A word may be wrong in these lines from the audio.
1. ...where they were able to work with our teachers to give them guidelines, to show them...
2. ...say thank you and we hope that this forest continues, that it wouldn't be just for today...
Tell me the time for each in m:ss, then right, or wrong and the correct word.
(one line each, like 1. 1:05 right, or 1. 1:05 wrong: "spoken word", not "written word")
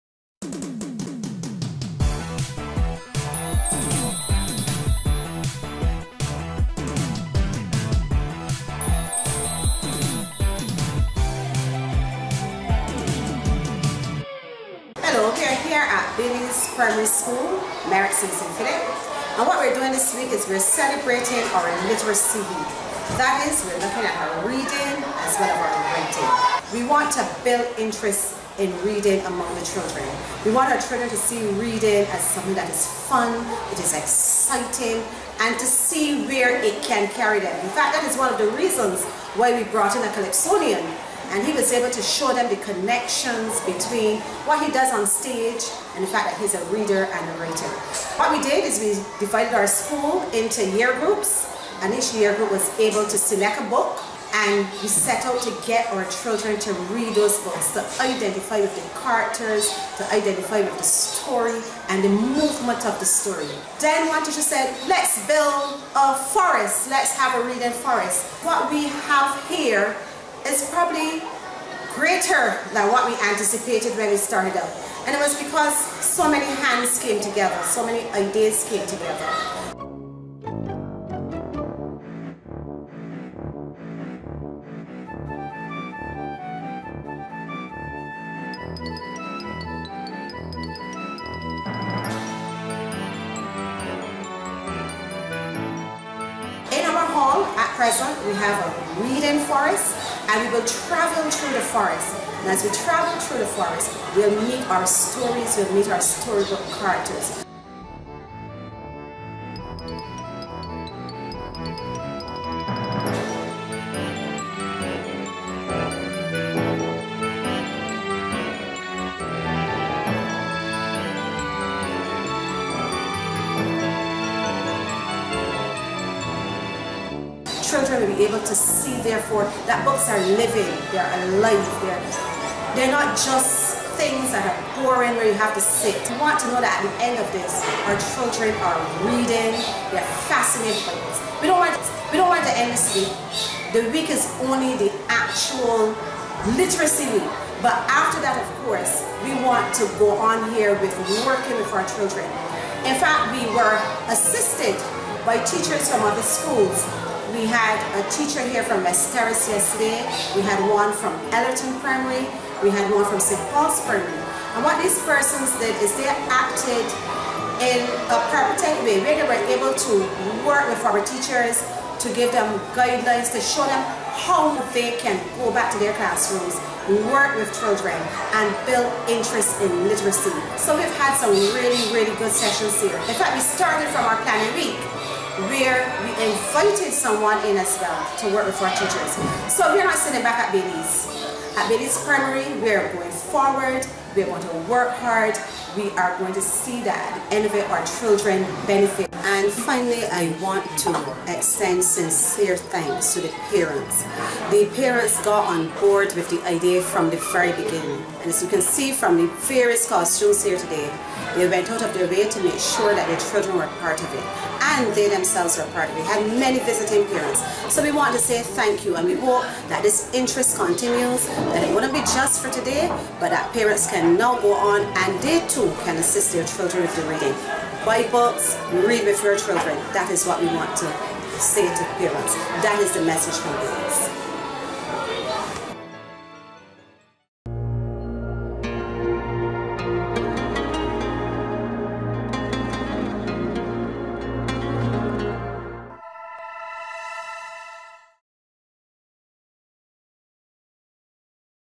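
1. 2:48 right
2. 3:38 wrong: "interest", not "forest".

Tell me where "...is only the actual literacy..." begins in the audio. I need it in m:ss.
2:24.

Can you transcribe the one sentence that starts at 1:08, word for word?
What we have here is probably greater than what we anticipated when we started out.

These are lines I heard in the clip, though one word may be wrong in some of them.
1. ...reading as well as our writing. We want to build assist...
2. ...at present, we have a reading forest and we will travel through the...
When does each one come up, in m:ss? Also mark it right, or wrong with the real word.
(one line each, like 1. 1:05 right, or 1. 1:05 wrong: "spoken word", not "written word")
1. 0:24 wrong: "interest", not "assist"
2. 1:37 right.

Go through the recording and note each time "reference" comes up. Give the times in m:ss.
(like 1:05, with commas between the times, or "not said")
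not said.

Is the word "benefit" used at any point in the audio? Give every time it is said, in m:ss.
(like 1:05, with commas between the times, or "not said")
3:18.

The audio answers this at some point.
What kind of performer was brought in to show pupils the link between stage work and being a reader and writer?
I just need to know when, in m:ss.
0:40.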